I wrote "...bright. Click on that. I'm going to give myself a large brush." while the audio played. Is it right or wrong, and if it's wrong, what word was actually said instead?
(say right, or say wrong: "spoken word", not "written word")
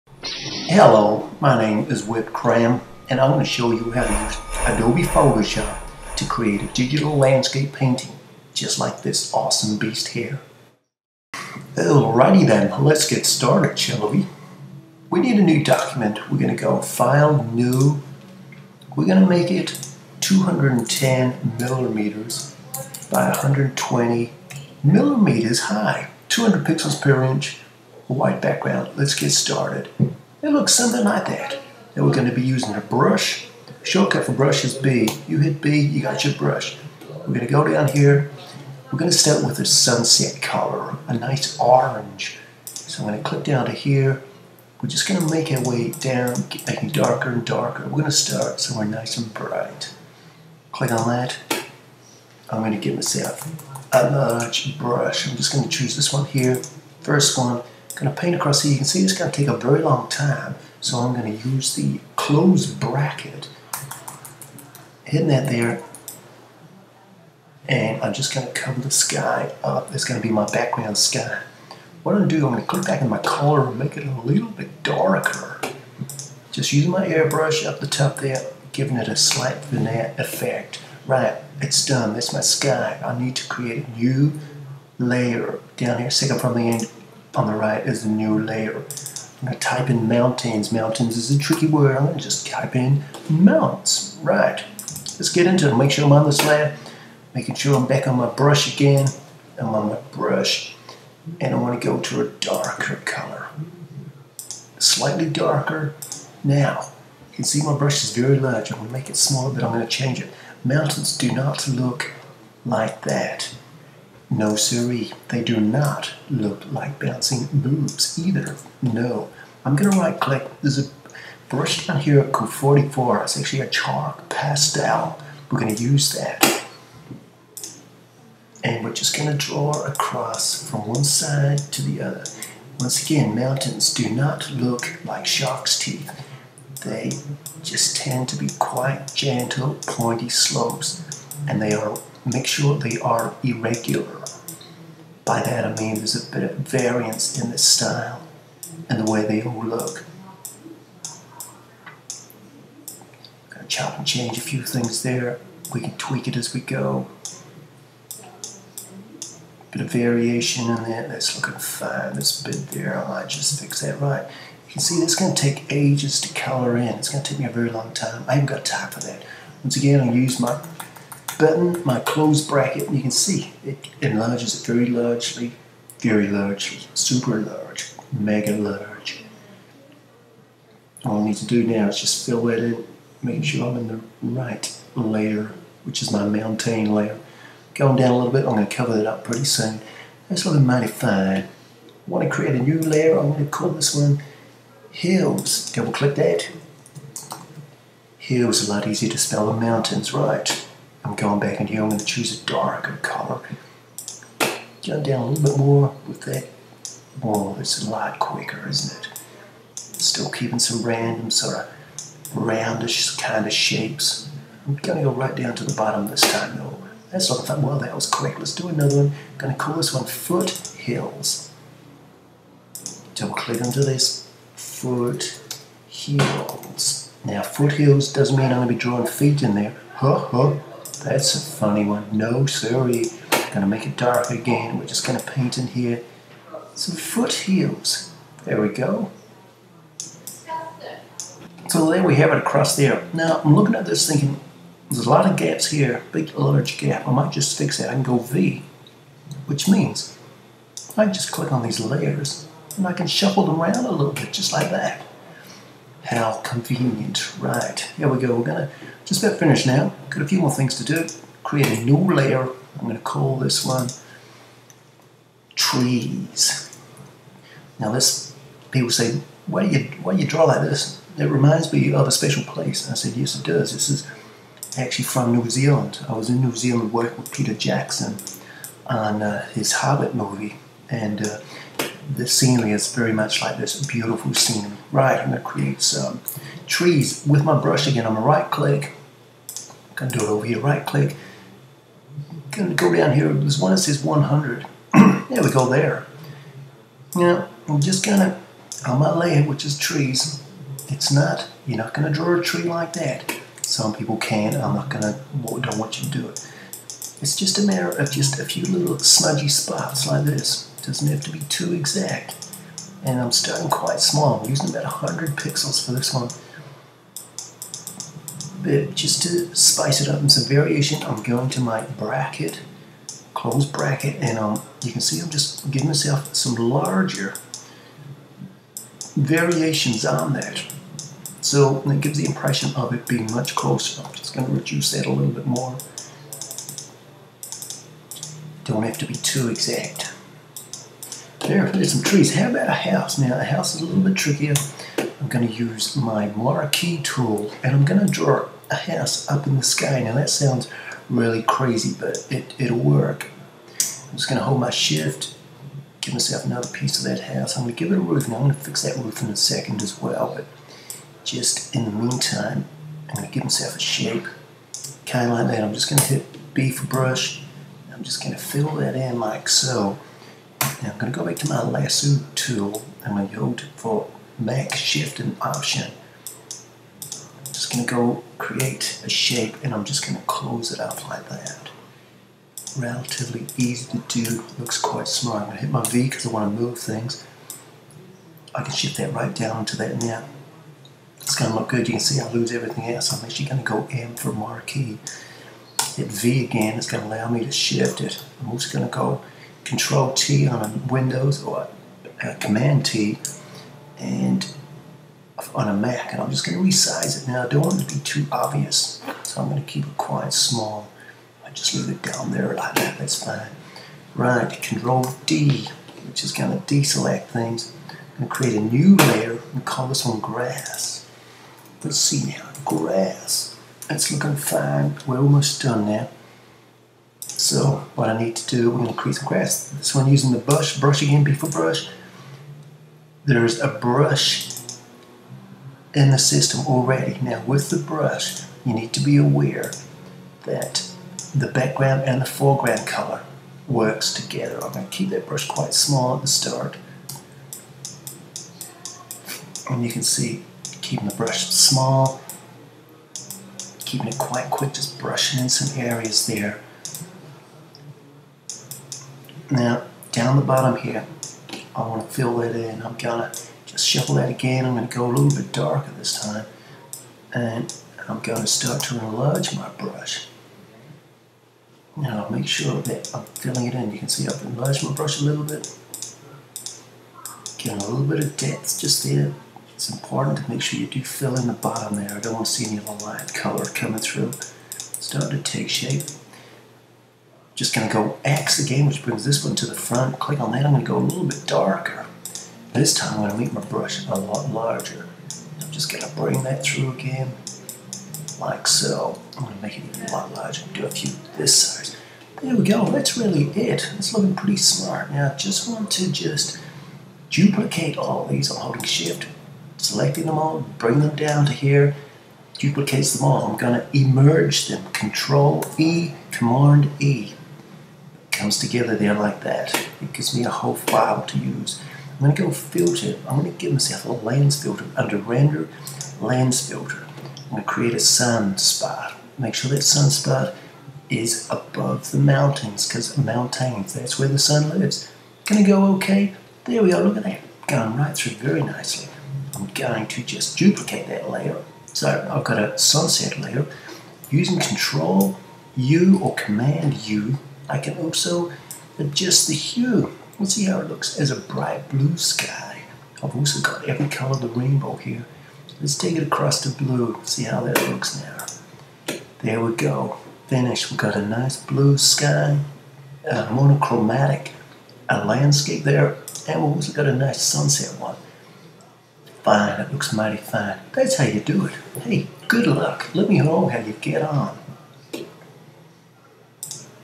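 right.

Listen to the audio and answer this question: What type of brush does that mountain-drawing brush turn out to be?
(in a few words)
Chalk pastel.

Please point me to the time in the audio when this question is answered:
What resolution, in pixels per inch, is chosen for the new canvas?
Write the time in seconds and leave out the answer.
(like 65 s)
26 s.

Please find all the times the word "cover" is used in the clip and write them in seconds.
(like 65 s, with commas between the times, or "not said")
68 s, 188 s.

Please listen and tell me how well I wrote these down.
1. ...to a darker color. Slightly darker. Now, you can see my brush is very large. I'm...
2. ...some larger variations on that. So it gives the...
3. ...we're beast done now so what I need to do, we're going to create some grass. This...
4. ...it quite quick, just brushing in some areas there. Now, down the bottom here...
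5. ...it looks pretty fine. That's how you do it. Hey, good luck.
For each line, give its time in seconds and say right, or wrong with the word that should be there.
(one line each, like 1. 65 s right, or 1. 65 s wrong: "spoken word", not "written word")
1. 101 s right
2. 326 s right
3. 425 s wrong: "almost", not "beast"
4. 454 s right
5. 569 s wrong: "mighty", not "pretty".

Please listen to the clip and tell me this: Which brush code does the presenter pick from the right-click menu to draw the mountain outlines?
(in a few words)
Q44.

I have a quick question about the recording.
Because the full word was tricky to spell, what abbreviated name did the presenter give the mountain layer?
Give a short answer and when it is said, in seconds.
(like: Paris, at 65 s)
Mounts, at 93 s.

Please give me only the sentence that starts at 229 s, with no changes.
Huh, huh, that's a funny one.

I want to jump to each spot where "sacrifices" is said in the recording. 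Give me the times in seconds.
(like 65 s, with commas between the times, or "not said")
not said.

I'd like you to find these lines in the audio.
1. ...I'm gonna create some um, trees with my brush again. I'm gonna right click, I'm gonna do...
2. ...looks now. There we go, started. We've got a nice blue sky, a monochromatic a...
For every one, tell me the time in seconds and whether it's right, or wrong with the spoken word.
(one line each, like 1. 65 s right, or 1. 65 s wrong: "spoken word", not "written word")
1. 285 s right
2. 557 s wrong: "finished", not "started".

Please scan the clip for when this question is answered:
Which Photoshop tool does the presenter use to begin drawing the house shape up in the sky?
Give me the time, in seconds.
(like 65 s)
346 s.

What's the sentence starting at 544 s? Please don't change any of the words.
Using Control U or Command U, I can also adjust the hue.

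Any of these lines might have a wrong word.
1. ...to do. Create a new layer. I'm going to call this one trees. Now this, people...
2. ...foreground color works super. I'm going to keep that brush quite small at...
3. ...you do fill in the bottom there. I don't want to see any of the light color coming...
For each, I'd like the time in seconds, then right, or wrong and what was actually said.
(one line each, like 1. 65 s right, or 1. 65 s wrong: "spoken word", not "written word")
1. 260 s right
2. 442 s wrong: "together", not "super"
3. 480 s right.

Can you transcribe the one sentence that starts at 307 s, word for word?
It's just a matter of just a few little smudgy spots like this.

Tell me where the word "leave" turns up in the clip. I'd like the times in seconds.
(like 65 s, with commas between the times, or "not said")
411 s.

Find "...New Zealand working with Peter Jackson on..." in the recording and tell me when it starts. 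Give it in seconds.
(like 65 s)
276 s.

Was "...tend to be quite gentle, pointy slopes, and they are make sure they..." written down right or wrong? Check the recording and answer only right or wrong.
right.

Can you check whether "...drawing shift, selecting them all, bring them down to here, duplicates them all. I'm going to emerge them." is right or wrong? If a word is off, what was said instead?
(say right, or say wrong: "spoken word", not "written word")
wrong: "holding", not "drawing".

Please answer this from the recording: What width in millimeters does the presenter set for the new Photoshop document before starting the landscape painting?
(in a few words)
210 millimeters.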